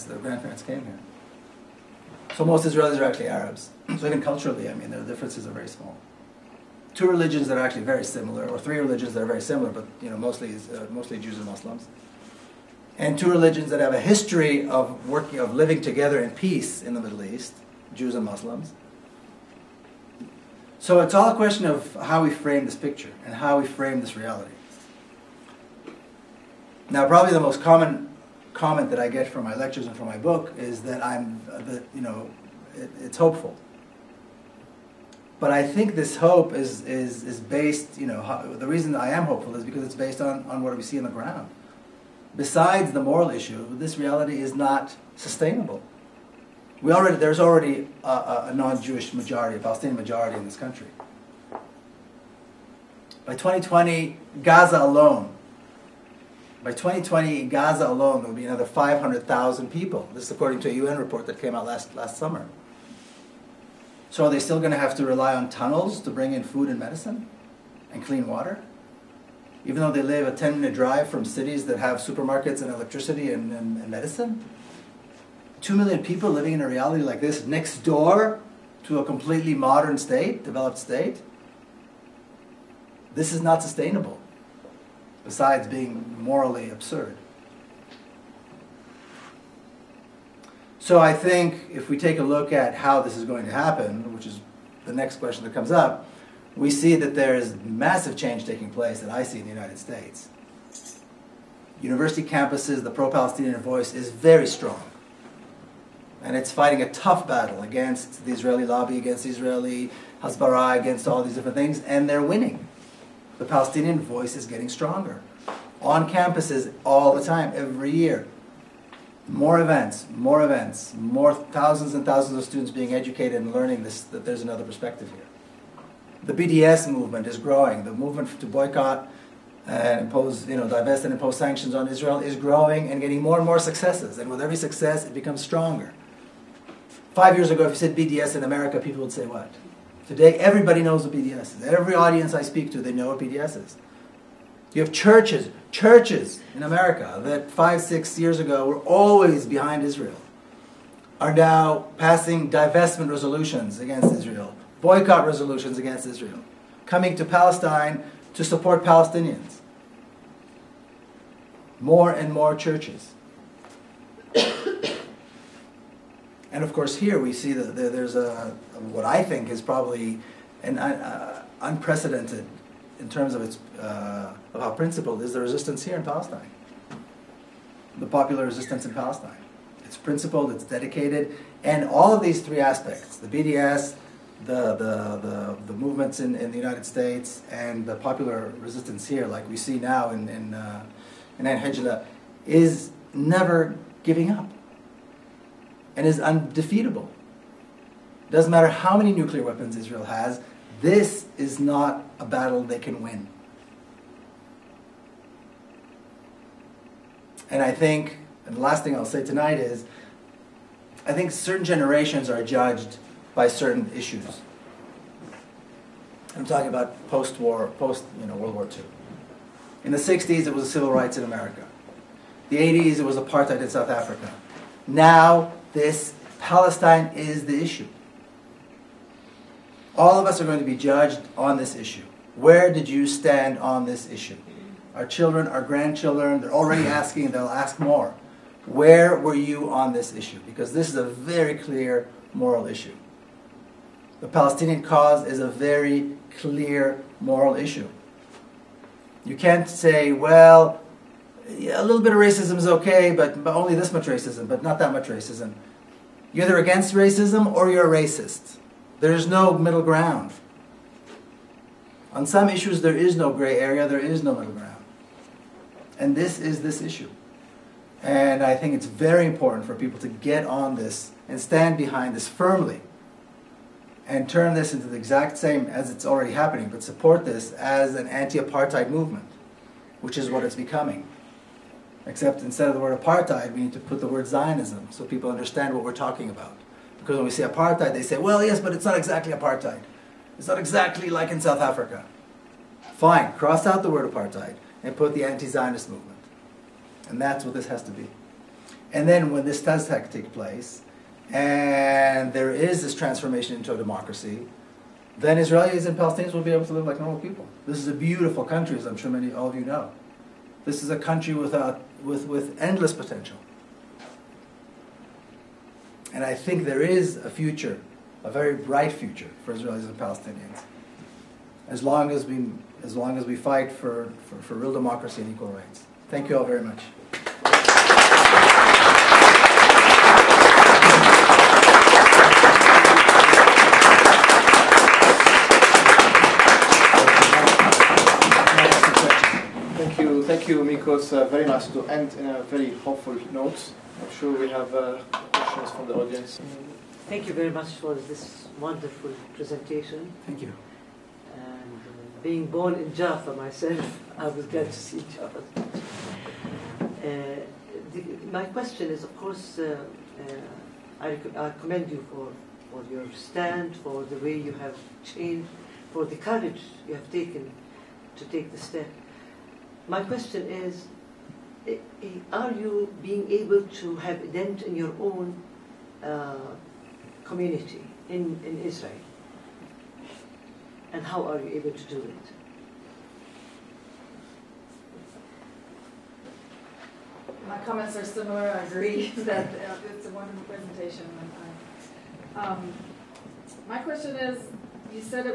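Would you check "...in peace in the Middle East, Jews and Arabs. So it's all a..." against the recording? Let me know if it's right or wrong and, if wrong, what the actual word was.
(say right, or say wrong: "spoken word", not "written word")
wrong: "Muslims", not "Arabs".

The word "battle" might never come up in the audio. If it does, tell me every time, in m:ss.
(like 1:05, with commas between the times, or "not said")
1:47, 3:22.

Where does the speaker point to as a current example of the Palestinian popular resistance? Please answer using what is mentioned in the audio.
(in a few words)
Ein Hijleh.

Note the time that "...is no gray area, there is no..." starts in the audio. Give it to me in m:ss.
4:22.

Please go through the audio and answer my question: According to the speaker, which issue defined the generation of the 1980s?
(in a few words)
Apartheid in South Africa.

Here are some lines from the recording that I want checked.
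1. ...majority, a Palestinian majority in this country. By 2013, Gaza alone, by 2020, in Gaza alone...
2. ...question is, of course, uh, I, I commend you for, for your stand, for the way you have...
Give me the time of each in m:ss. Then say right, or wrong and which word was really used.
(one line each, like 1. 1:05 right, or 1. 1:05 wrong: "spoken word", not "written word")
1. 0:49 wrong: "2020", not "2013"
2. 5:58 right.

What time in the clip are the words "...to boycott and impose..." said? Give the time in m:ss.
2:08.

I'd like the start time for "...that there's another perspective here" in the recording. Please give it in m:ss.
2:04.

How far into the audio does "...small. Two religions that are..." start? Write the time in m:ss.
0:05.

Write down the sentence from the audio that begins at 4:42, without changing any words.
Except instead of the word apartheid, we need to put the word Zionism so people understand what we're talking about.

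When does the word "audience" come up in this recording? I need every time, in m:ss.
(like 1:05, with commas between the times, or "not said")
2:21, 5:45.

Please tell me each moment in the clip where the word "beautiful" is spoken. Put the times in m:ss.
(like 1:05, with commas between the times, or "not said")
5:07.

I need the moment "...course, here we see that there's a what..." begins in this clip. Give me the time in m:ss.
2:46.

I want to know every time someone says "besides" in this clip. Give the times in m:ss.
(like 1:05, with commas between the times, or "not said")
0:42, 1:25.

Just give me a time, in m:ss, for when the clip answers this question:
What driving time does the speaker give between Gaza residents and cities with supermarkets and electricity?
1:10.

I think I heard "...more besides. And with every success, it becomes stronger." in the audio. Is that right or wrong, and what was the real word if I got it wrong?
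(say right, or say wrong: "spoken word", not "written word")
wrong: "successes", not "besides".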